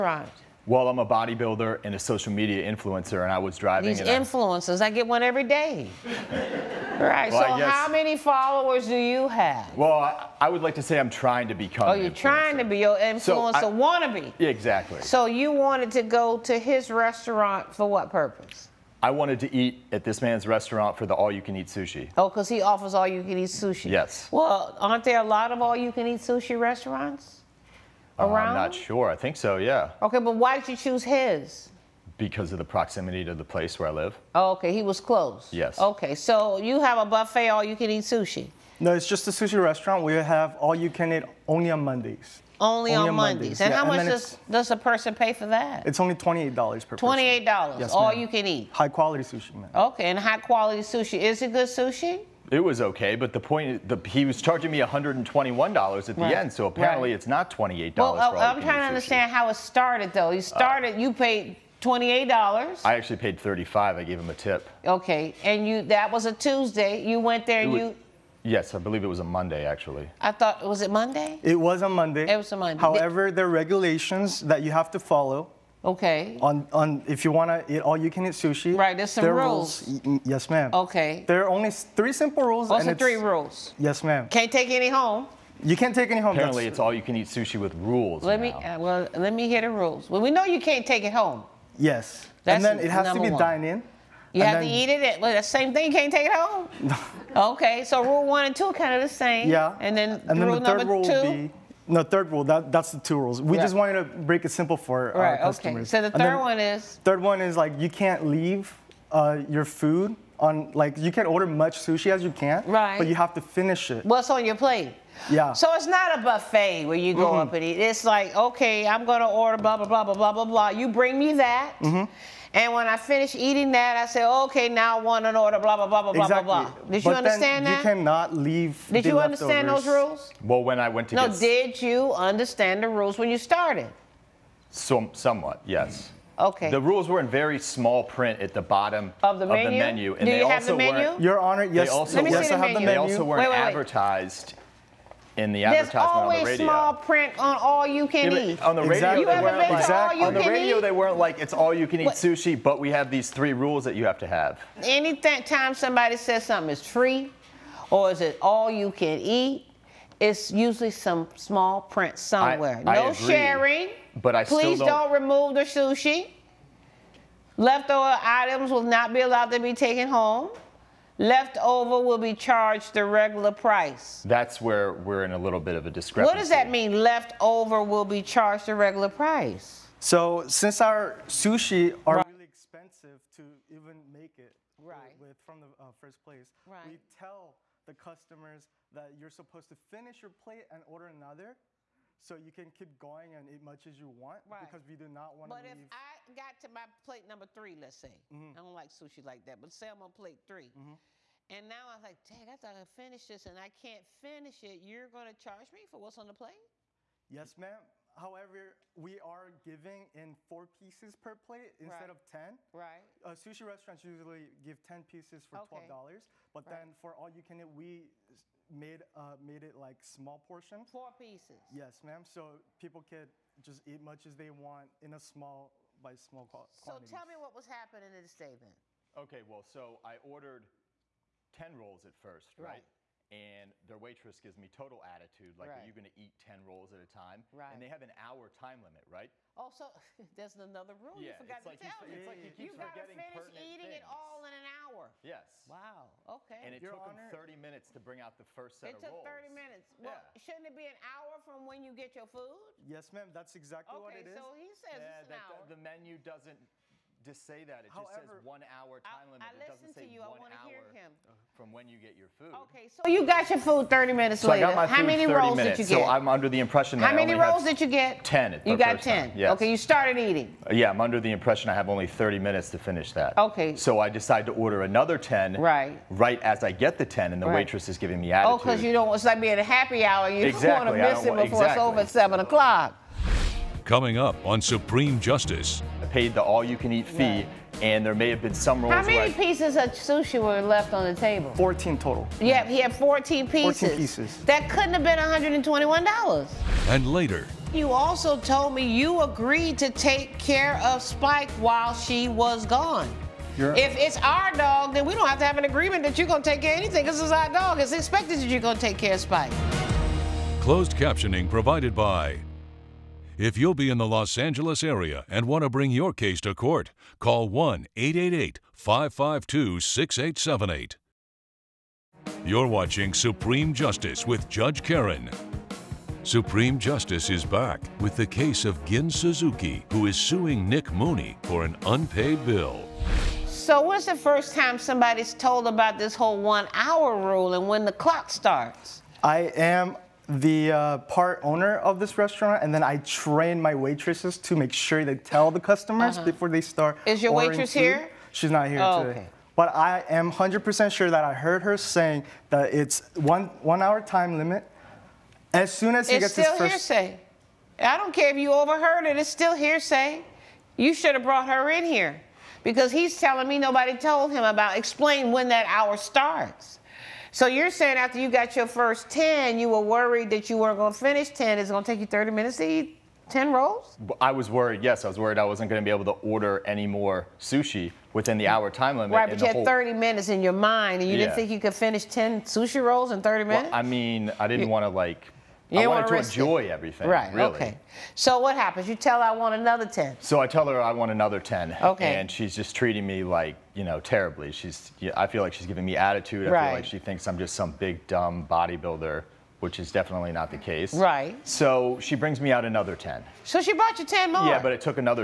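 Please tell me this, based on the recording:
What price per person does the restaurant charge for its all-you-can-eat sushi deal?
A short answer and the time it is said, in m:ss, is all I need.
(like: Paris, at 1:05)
$28, at 0:45.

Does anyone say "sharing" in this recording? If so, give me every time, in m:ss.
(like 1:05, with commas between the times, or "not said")
2:43.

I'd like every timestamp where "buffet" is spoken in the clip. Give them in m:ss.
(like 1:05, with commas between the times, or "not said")
0:37, 1:56.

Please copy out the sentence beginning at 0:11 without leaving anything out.
Oh, you're trying to be your influencer so I...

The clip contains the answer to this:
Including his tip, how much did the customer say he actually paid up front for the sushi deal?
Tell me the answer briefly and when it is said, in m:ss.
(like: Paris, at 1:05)
35, at 1:02.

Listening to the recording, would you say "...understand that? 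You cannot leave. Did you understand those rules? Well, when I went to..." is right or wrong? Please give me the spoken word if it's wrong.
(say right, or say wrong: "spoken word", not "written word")
right.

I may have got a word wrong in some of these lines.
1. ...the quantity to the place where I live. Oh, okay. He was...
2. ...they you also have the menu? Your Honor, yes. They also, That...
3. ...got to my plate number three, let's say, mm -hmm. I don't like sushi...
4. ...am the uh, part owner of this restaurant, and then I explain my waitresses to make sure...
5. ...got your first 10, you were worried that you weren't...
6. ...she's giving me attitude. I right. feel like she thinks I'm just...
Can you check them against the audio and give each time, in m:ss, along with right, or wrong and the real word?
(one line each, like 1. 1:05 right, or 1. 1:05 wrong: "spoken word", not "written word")
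1. 0:32 wrong: "proximity", not "quantity"
2. 2:20 wrong: "Let", not "That"
3. 3:16 right
4. 5:39 wrong: "train", not "explain"
5. 6:08 right
6. 6:35 right.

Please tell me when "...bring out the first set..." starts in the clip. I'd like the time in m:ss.
4:07.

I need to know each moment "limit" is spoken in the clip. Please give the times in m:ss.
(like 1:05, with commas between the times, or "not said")
3:58, 4:19, 5:54, 6:18.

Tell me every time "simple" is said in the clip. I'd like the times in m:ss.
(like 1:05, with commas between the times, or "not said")
1:22, 1:44.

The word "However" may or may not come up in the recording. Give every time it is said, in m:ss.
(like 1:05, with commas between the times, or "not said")
1:12, 3:28, 4:17.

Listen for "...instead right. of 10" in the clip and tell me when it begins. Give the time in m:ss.
3:31.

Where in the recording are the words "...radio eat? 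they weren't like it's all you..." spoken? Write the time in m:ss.
2:30.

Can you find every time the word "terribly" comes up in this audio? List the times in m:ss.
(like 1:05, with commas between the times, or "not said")
6:33.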